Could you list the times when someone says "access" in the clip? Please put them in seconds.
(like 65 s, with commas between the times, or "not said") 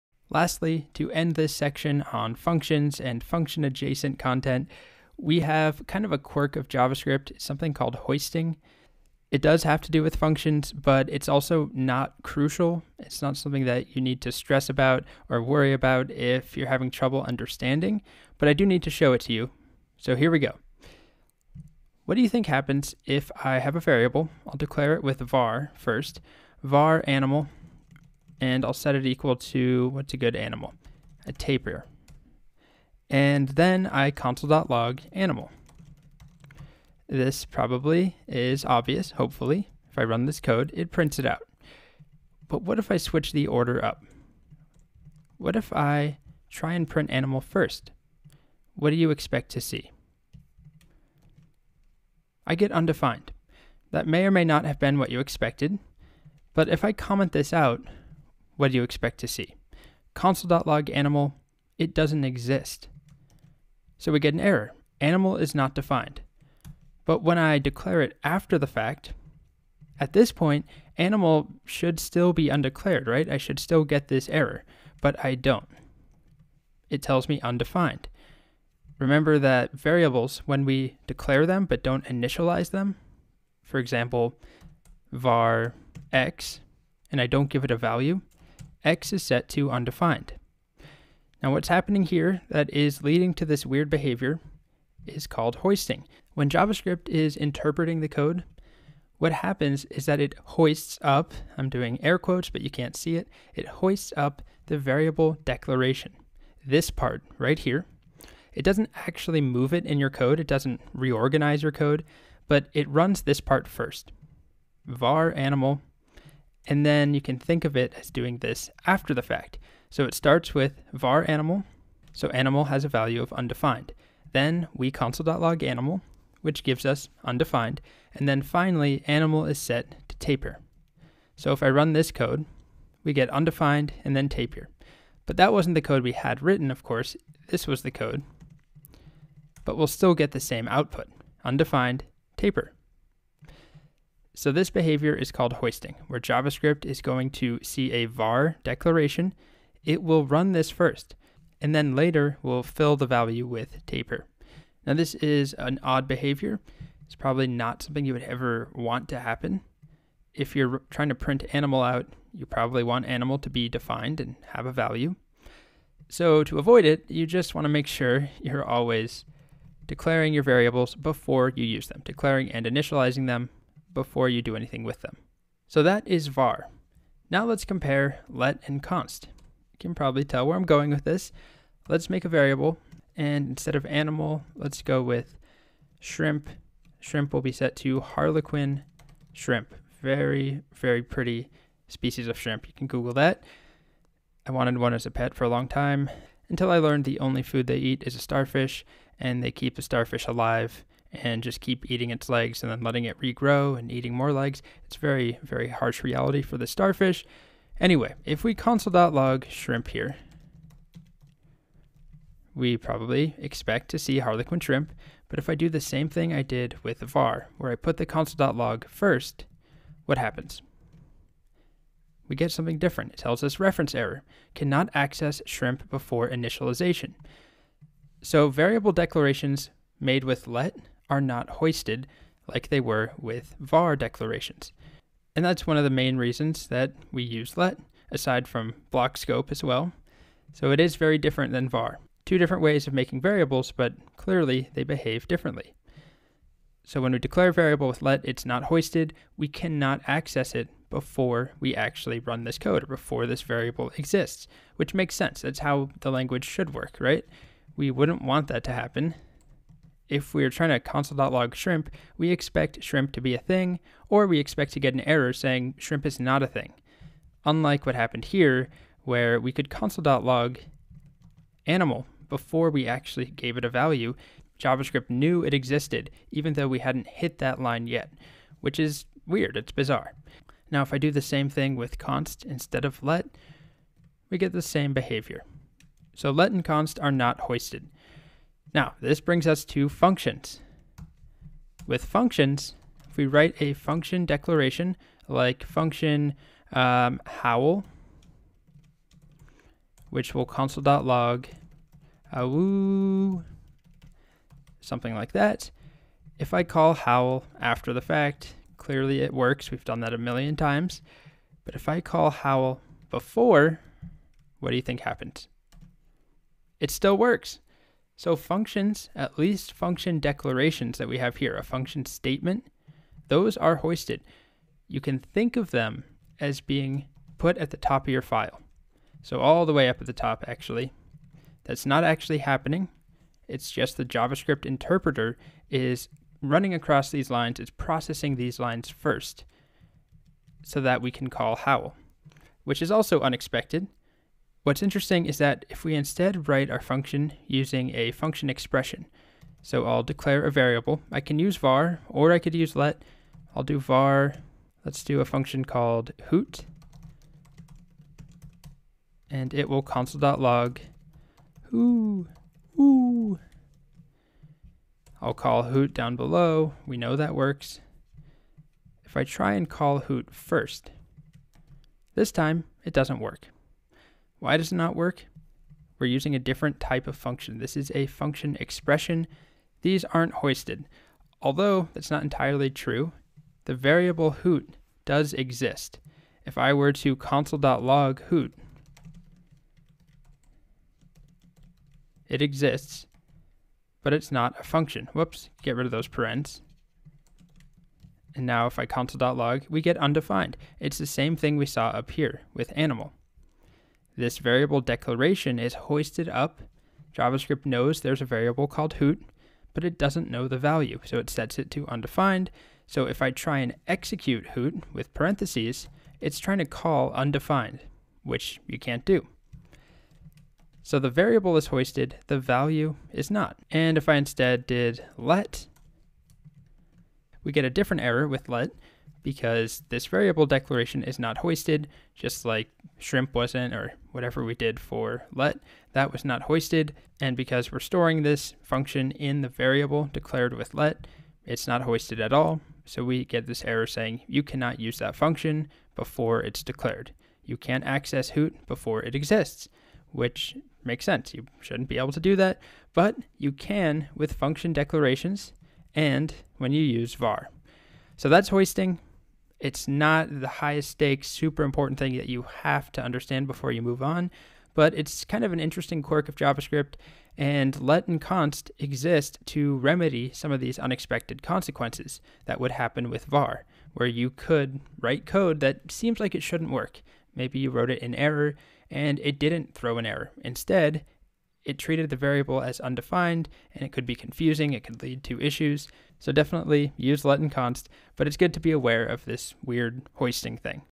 224 s, 250 s, 447 s.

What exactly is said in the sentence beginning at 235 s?
And that's one of the main reasons that we use let, aside from block scope as well.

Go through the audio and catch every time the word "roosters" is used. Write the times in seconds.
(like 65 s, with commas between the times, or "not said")
not said.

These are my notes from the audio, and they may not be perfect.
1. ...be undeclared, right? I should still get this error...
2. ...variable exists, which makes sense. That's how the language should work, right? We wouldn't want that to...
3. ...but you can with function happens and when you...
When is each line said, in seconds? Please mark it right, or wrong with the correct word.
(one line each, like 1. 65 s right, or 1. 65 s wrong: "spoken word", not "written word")
1. 72 s right
2. 253 s right
3. 452 s wrong: "declarations", not "happens".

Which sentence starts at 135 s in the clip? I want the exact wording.
But that wasn't the code we had written, of course.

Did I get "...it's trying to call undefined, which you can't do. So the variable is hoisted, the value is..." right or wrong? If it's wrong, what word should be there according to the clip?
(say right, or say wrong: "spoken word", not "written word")
right.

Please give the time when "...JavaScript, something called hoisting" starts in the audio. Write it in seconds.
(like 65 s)
6 s.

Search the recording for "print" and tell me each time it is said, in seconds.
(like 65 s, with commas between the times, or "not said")
40 s, 46 s, 161 s.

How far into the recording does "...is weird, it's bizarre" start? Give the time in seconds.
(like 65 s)
278 s.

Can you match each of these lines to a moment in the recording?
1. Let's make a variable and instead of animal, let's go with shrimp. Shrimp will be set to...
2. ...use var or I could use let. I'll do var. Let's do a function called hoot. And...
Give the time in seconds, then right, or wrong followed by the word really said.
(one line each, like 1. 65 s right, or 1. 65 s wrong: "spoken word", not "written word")
1. 181 s right
2. 351 s right.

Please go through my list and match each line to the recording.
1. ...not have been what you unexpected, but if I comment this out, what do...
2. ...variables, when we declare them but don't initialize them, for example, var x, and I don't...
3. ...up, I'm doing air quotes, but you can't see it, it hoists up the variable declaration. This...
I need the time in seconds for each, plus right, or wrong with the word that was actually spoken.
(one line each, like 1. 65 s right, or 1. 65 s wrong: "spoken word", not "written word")
1. 54 s wrong: "expected", not "unexpected"
2. 79 s right
3. 101 s right.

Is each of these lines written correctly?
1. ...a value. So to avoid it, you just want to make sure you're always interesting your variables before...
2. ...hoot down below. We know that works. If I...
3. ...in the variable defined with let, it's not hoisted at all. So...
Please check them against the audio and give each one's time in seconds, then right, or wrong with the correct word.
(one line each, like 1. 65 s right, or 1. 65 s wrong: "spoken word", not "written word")
1. 164 s wrong: "declaring", not "interesting"
2. 365 s right
3. 439 s wrong: "declared", not "defined".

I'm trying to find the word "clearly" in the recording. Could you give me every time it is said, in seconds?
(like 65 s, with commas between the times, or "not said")
244 s, 308 s.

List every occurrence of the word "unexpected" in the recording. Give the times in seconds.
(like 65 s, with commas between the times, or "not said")
343 s, 470 s.